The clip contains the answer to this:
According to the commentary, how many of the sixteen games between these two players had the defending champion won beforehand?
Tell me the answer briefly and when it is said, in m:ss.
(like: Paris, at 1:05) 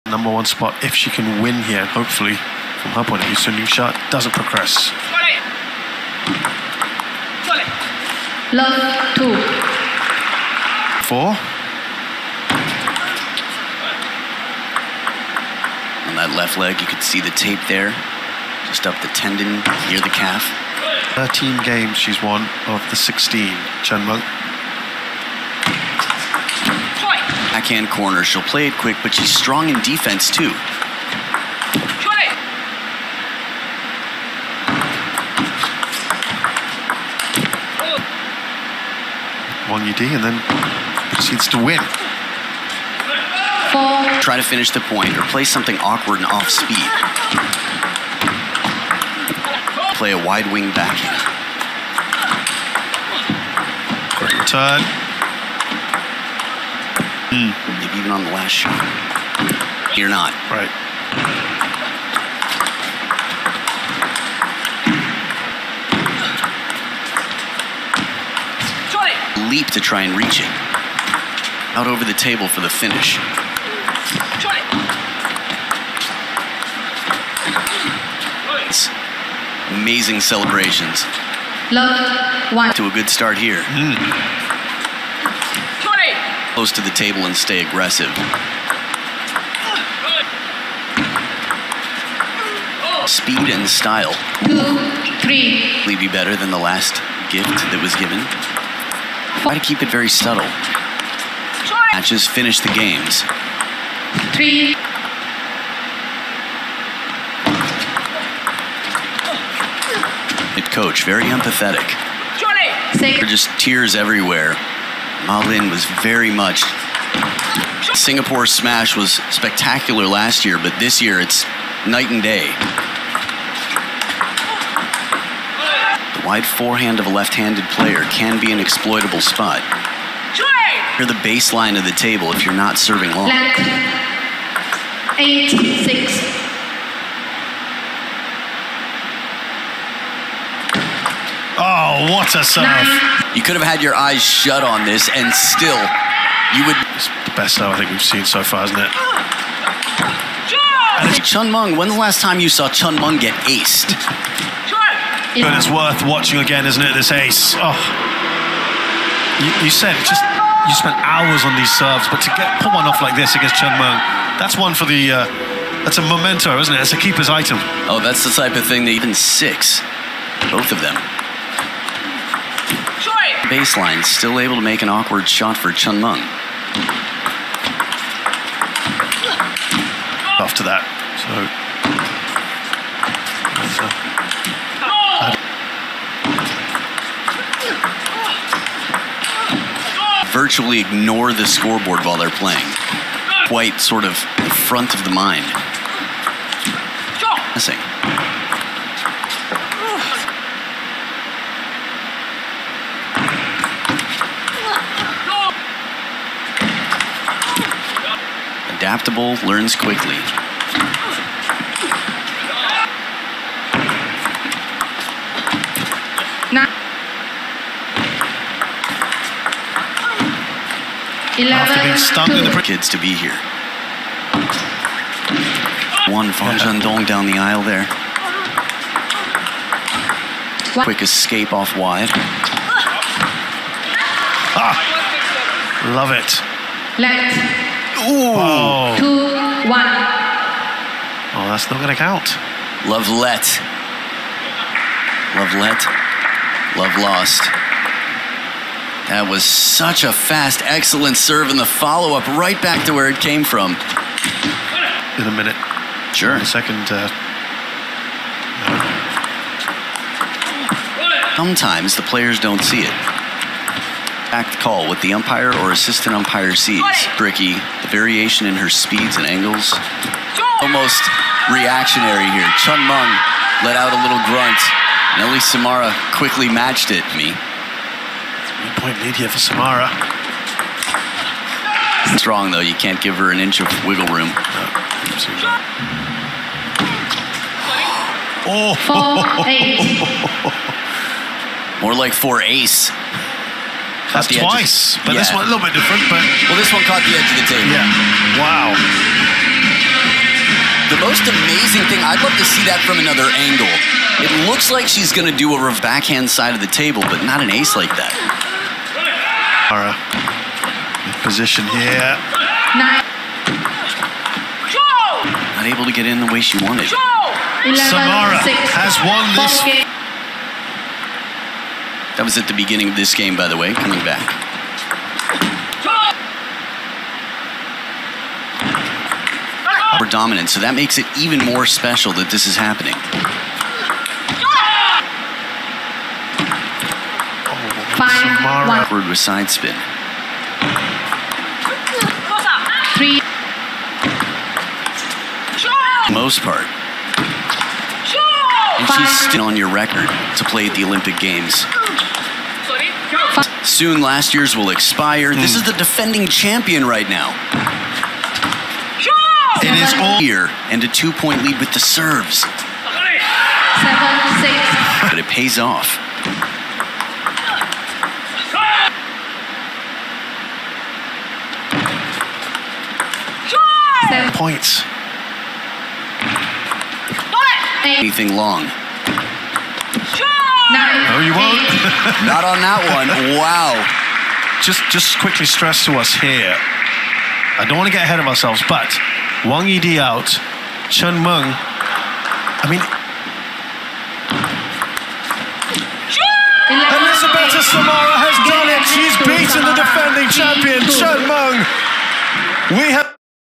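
13, at 0:21.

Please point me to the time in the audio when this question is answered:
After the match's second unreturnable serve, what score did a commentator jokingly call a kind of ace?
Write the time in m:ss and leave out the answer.
4:48.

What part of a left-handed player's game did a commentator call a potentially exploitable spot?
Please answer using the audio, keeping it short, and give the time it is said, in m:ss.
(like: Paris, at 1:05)
The wide forehand, at 2:06.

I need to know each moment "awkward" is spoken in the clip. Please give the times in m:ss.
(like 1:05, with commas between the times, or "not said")
0:45, 2:54.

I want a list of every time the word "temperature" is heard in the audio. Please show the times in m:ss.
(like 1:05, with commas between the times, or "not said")
not said.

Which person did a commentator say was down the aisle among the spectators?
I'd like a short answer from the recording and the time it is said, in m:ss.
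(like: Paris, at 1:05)
Zhendong, at 3:46.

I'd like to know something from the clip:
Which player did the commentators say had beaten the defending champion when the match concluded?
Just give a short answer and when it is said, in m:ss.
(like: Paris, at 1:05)
Elizabeta Samara, at 6:36.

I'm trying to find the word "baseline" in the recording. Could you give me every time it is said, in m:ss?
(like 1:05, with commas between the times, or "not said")
2:11, 2:53.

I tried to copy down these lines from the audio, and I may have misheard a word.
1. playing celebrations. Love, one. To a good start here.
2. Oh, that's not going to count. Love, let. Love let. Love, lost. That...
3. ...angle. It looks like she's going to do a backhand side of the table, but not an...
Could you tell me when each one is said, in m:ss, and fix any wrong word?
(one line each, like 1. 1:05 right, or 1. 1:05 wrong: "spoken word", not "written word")
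1. 1:19 wrong: "amazing", not "playing"
2. 4:01 right
3. 5:03 right.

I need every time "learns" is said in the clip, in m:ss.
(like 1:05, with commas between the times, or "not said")
3:29.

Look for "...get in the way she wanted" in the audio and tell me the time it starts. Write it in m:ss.
5:15.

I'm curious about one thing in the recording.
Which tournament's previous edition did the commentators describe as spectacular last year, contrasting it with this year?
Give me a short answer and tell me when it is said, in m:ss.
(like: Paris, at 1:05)
Singapore Smash, at 1:57.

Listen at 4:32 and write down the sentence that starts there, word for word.
Chen Meng let out a little grunt.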